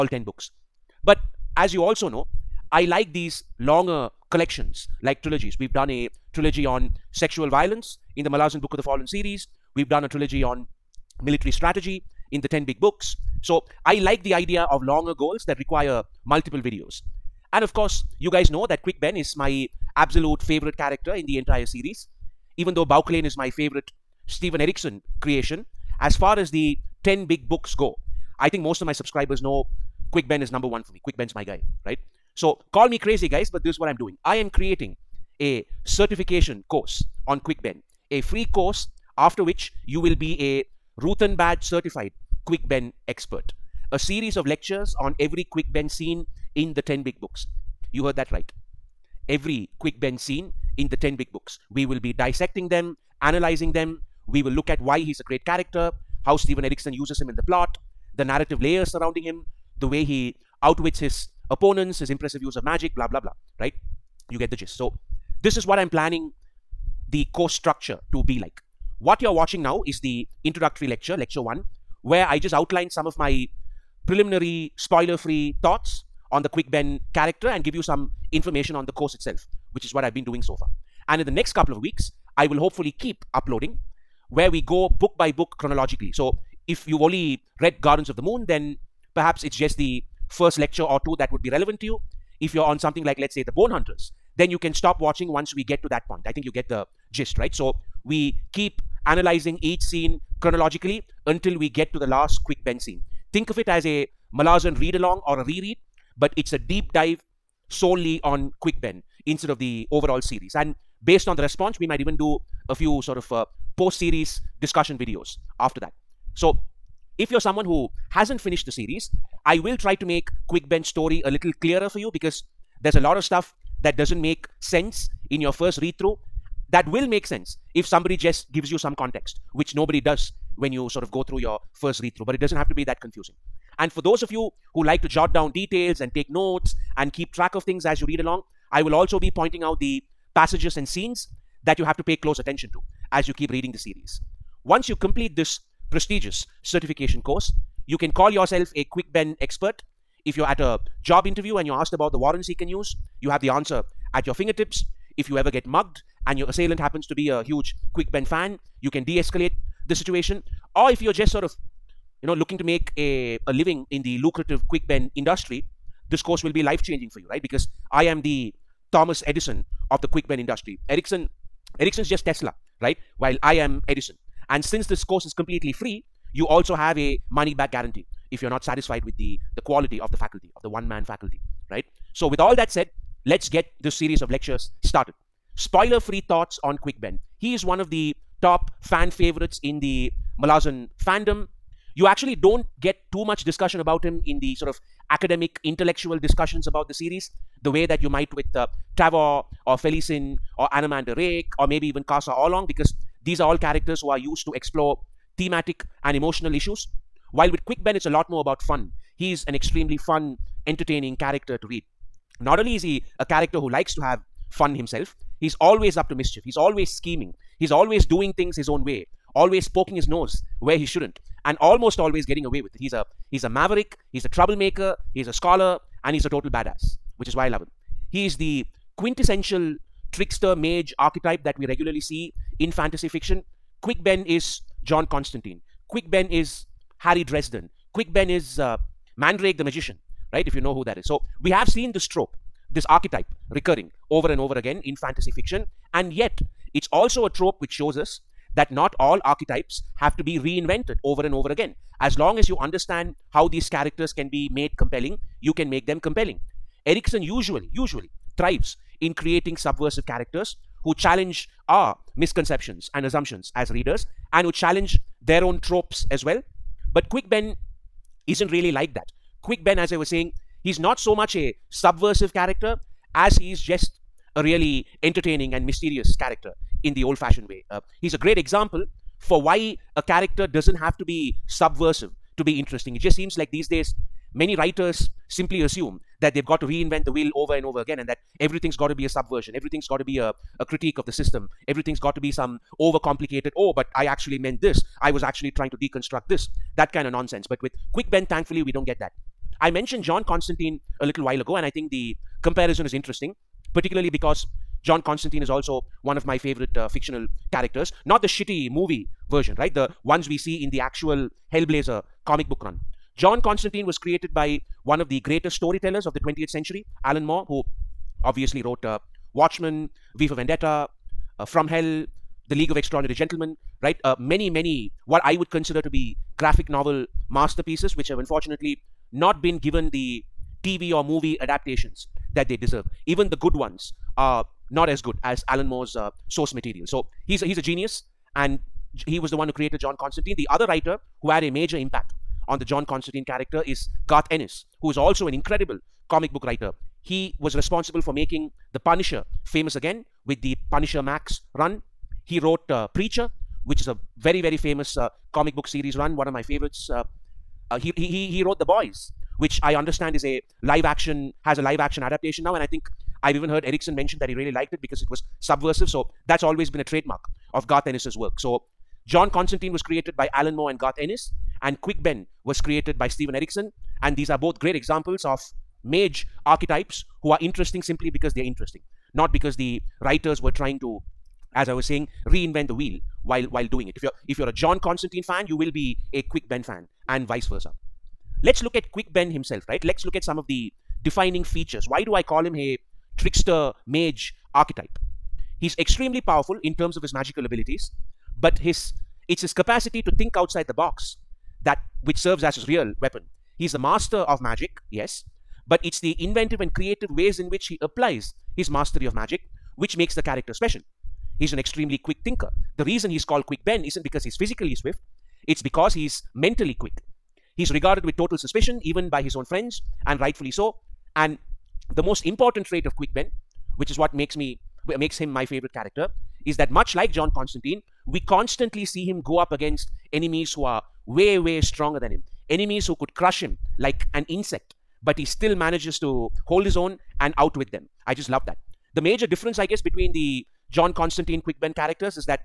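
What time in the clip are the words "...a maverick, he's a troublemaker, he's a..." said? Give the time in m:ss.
3:43.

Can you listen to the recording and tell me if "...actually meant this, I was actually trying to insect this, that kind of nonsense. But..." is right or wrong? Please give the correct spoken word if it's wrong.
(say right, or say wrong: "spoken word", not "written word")
wrong: "deconstruct", not "insect".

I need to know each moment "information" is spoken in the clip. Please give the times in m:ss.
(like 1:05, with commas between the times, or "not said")
1:18.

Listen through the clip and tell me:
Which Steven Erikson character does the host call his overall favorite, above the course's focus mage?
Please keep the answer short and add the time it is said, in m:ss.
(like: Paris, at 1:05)
Bauchelain, at 0:22.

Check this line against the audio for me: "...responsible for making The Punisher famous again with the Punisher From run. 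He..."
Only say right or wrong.
wrong.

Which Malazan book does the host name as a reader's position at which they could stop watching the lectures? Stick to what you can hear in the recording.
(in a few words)
The Bone Hunters.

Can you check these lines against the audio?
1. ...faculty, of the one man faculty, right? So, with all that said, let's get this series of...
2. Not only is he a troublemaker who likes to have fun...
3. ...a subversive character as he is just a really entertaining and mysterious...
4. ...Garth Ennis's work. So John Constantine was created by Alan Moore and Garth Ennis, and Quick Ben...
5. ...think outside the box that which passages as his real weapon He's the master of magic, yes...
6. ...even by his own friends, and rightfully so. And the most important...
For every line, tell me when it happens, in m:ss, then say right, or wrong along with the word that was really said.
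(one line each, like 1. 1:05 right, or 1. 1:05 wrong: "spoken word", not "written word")
1. 3:00 right
2. 3:32 wrong: "character", not "troublemaker"
3. 4:31 right
4. 6:07 right
5. 6:40 wrong: "serves", not "passages"
6. 6:58 right.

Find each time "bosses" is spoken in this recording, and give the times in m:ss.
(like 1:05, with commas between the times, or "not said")
not said.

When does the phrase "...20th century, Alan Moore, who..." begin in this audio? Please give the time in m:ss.
5:16.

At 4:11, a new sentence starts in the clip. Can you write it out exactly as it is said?
As long as you understand how these characters can be made compelling, you can make them compelling.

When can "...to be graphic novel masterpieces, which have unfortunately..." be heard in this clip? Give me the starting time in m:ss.
5:25.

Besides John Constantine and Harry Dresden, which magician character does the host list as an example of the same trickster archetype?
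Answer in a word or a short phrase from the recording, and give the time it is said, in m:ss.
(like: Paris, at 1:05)
Mandrake the magician, at 3:59.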